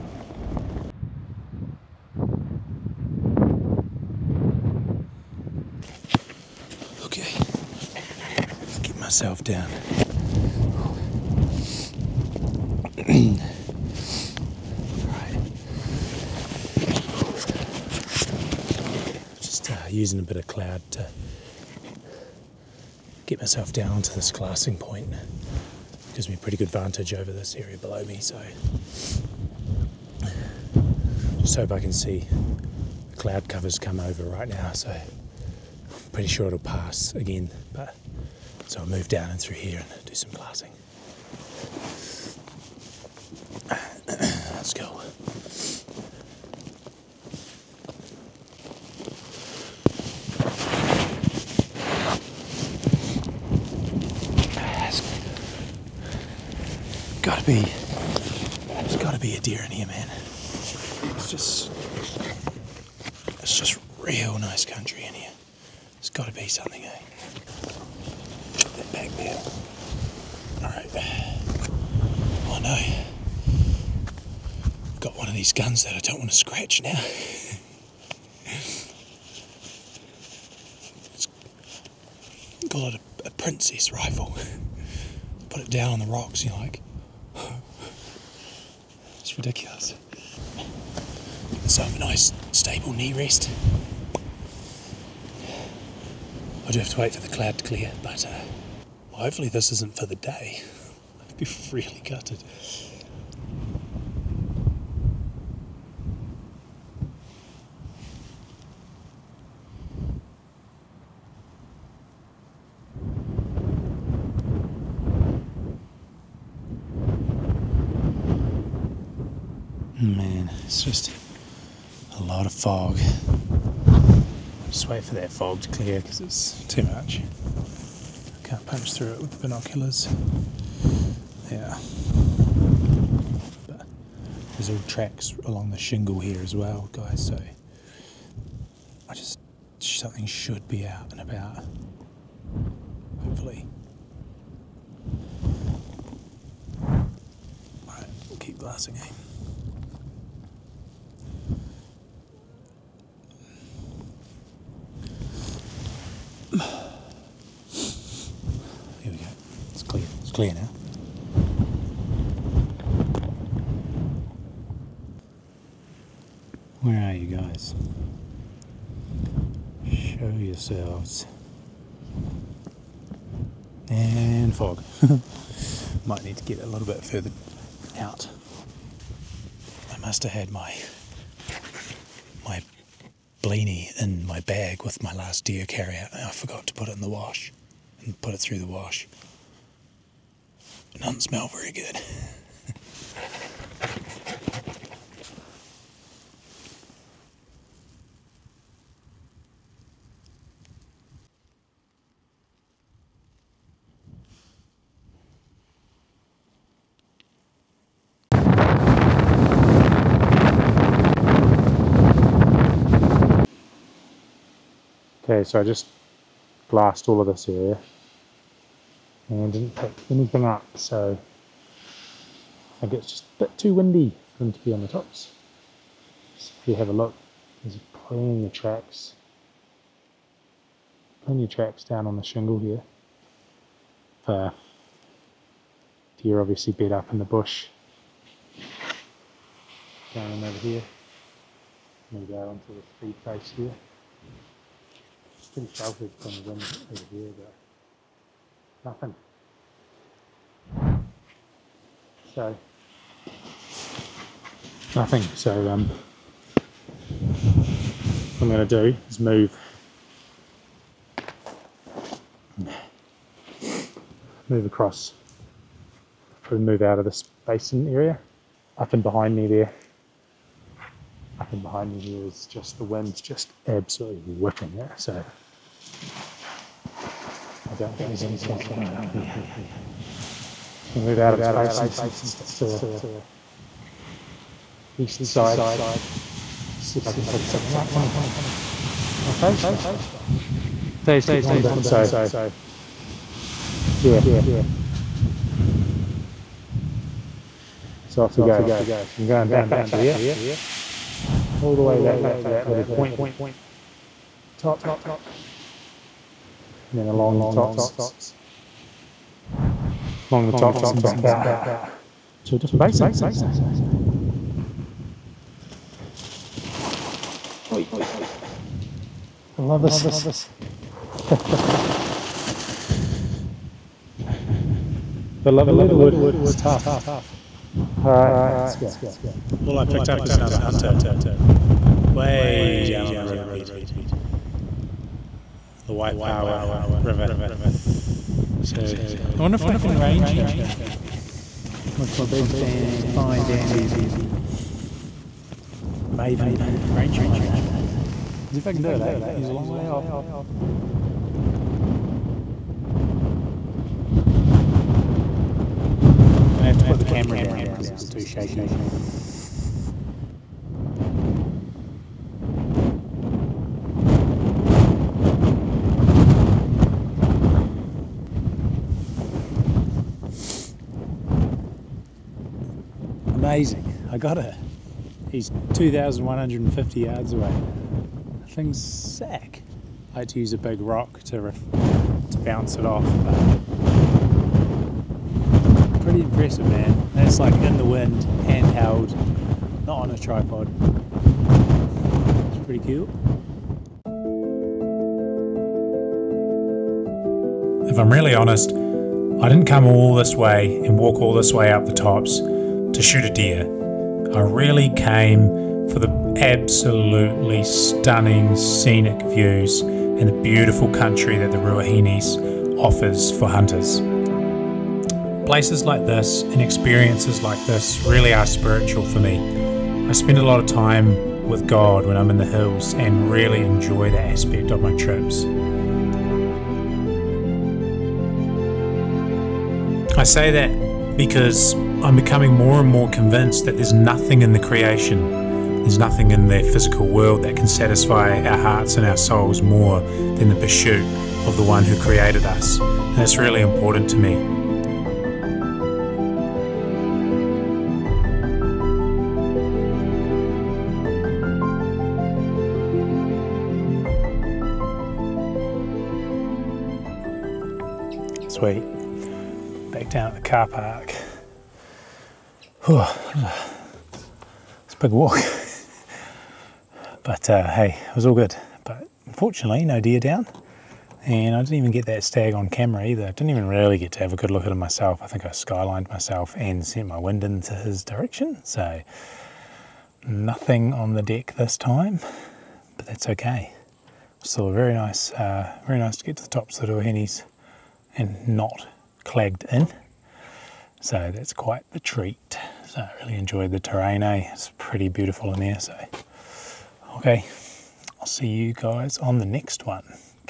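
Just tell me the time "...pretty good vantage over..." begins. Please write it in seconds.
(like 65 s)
26 s.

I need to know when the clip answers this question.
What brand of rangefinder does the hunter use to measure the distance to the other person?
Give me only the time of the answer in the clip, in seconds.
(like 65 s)
346 s.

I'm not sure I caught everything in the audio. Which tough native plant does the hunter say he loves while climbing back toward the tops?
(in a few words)
leatherwood.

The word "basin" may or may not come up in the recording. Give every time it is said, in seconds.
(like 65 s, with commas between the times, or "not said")
267 s, 281 s, 312 s.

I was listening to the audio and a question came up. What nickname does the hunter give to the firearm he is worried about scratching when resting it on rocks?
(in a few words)
princess rifle.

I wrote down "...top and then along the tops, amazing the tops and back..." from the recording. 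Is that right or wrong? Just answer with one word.
wrong.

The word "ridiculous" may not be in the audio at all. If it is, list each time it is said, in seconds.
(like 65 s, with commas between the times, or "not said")
89 s.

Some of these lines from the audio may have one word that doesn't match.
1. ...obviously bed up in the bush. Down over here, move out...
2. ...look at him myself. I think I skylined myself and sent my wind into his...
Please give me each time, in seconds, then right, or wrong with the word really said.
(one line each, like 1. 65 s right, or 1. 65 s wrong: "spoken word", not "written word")
1. 236 s right
2. 474 s right.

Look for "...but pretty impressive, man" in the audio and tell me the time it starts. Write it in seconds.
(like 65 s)
383 s.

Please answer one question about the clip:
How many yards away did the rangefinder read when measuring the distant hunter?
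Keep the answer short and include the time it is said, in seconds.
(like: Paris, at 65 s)
2,150 yards, at 375 s.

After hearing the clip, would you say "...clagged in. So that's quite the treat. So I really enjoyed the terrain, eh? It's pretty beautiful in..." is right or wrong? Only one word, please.
right.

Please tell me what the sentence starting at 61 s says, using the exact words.
It's just, it's just real nice country in here.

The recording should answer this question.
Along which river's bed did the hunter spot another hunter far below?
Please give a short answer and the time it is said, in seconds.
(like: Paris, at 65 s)
Waipawa River, at 335 s.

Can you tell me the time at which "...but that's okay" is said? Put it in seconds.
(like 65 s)
482 s.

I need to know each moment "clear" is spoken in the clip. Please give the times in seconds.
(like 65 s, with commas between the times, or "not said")
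97 s, 125 s, 160 s.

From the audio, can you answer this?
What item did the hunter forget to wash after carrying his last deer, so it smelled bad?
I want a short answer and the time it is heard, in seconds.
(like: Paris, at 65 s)
Blaney, at 183 s.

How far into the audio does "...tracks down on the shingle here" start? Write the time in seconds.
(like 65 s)
231 s.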